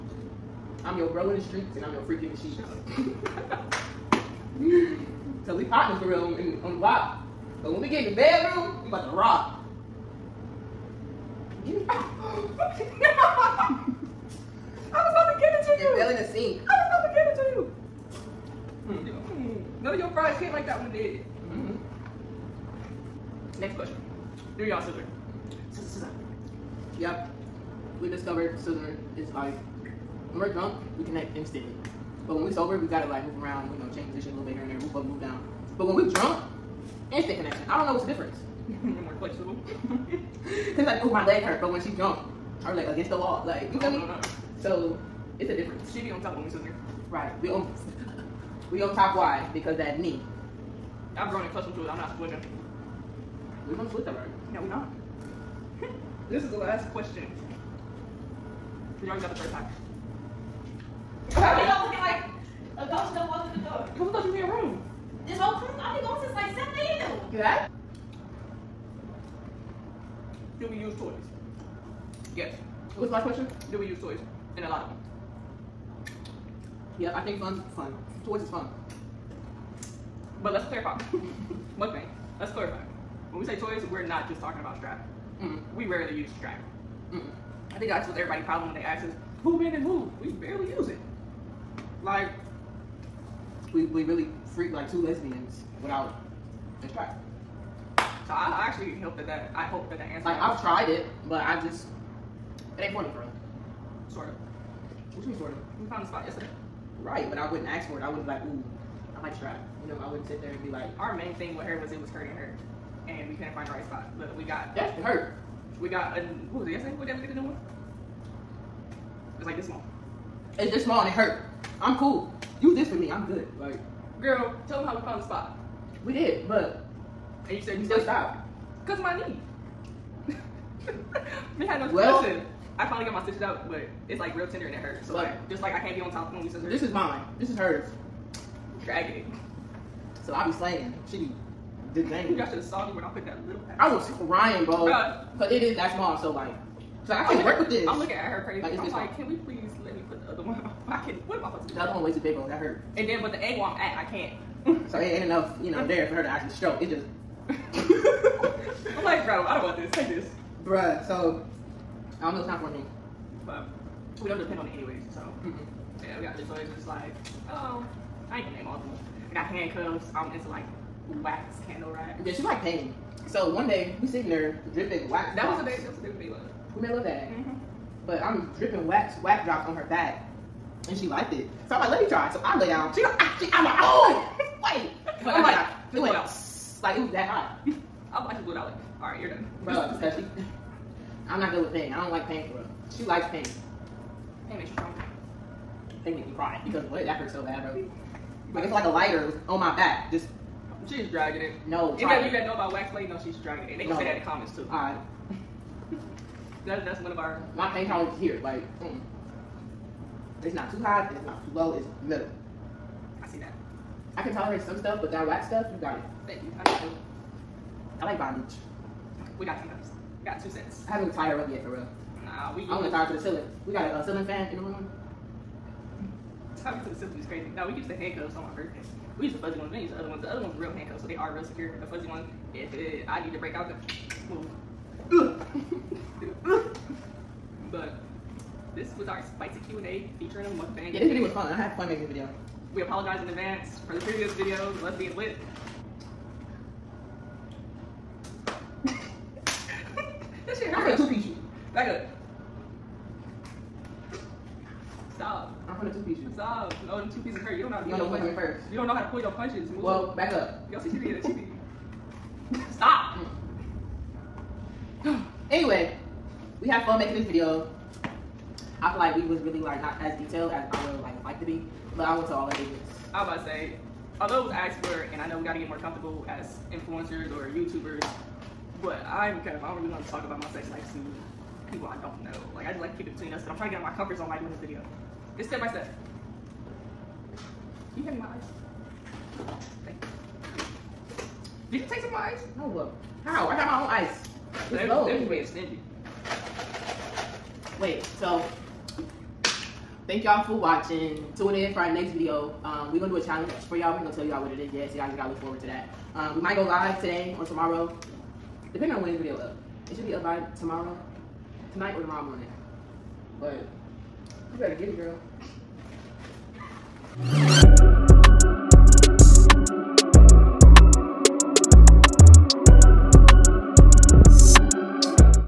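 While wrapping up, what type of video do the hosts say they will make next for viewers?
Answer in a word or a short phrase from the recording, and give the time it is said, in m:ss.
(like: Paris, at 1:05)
a challenge, at 5:03.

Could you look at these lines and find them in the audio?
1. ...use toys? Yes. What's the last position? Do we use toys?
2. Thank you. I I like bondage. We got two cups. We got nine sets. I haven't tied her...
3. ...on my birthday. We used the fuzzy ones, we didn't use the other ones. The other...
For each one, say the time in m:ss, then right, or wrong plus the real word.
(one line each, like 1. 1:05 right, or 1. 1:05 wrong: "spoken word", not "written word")
1. 1:10 wrong: "question", not "position"
2. 3:36 wrong: "two", not "nine"
3. 3:48 right.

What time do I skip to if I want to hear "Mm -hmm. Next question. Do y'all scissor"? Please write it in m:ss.
0:21.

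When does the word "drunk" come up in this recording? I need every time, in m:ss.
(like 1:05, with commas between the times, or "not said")
0:30, 0:36.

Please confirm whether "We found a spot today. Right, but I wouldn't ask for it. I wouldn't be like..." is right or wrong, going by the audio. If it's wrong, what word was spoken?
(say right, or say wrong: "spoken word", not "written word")
wrong: "yesterday", not "today".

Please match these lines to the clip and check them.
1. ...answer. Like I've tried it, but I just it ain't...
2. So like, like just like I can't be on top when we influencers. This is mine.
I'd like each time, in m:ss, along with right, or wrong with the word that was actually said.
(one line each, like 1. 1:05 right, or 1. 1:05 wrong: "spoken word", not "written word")
1. 1:40 right
2. 2:15 wrong: "scissors", not "influencers".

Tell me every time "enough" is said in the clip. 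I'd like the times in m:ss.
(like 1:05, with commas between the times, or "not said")
2:35.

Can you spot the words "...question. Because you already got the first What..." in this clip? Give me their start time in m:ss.
0:56.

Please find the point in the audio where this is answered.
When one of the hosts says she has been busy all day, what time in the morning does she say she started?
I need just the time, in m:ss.
1:06.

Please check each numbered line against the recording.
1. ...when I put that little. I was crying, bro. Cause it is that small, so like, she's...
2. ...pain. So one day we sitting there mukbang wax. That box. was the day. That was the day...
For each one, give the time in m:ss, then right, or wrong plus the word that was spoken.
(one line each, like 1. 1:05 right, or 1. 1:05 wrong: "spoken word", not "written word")
1. 2:22 right
2. 2:52 wrong: "dripping", not "mukbang".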